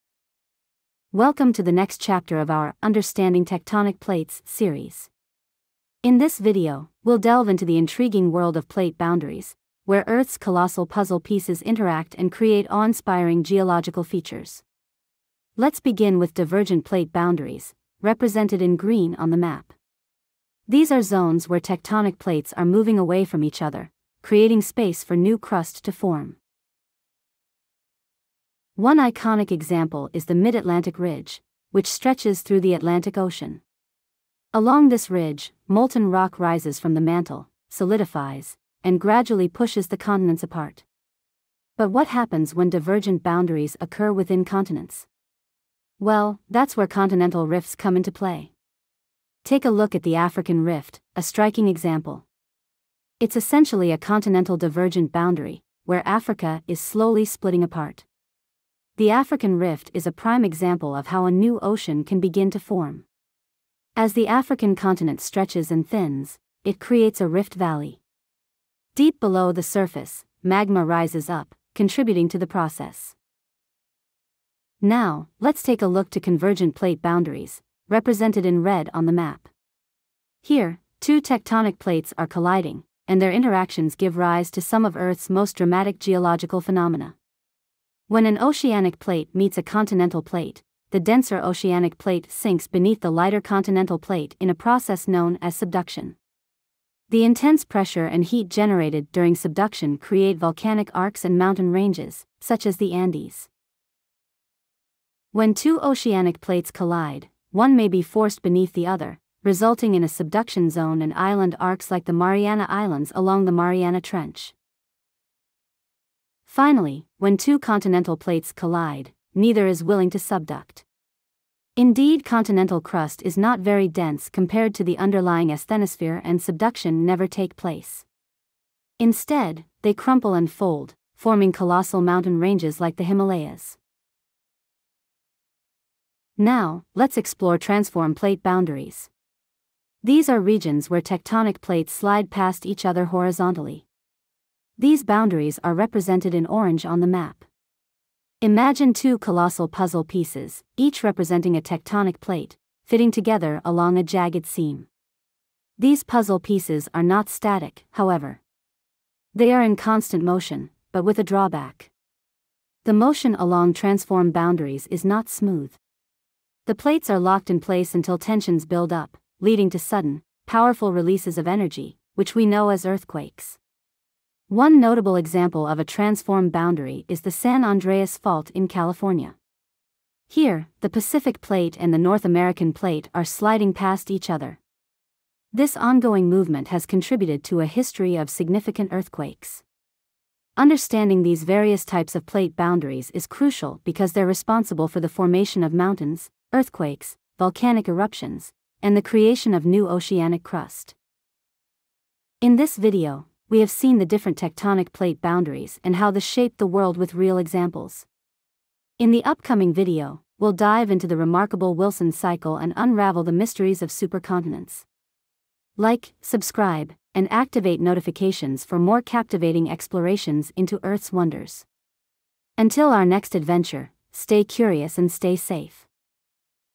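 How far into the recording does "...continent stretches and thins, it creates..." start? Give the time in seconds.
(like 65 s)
64 s.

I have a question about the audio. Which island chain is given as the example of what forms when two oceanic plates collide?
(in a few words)
Mariana Islands.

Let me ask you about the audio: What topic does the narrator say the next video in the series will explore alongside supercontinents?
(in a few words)
Wilson cycle.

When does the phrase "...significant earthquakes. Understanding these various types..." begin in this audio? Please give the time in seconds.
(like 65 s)
188 s.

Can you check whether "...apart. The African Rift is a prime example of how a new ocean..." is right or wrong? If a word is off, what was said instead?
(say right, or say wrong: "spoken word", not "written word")
right.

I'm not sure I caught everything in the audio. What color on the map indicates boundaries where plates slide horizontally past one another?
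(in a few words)
Orange.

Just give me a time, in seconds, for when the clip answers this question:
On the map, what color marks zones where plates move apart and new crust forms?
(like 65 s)
18 s.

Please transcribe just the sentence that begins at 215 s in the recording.
Like, subscribe, and activate notifications for more captivating explorations into Earth's wonders.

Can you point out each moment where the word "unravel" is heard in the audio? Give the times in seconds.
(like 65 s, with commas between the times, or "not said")
212 s.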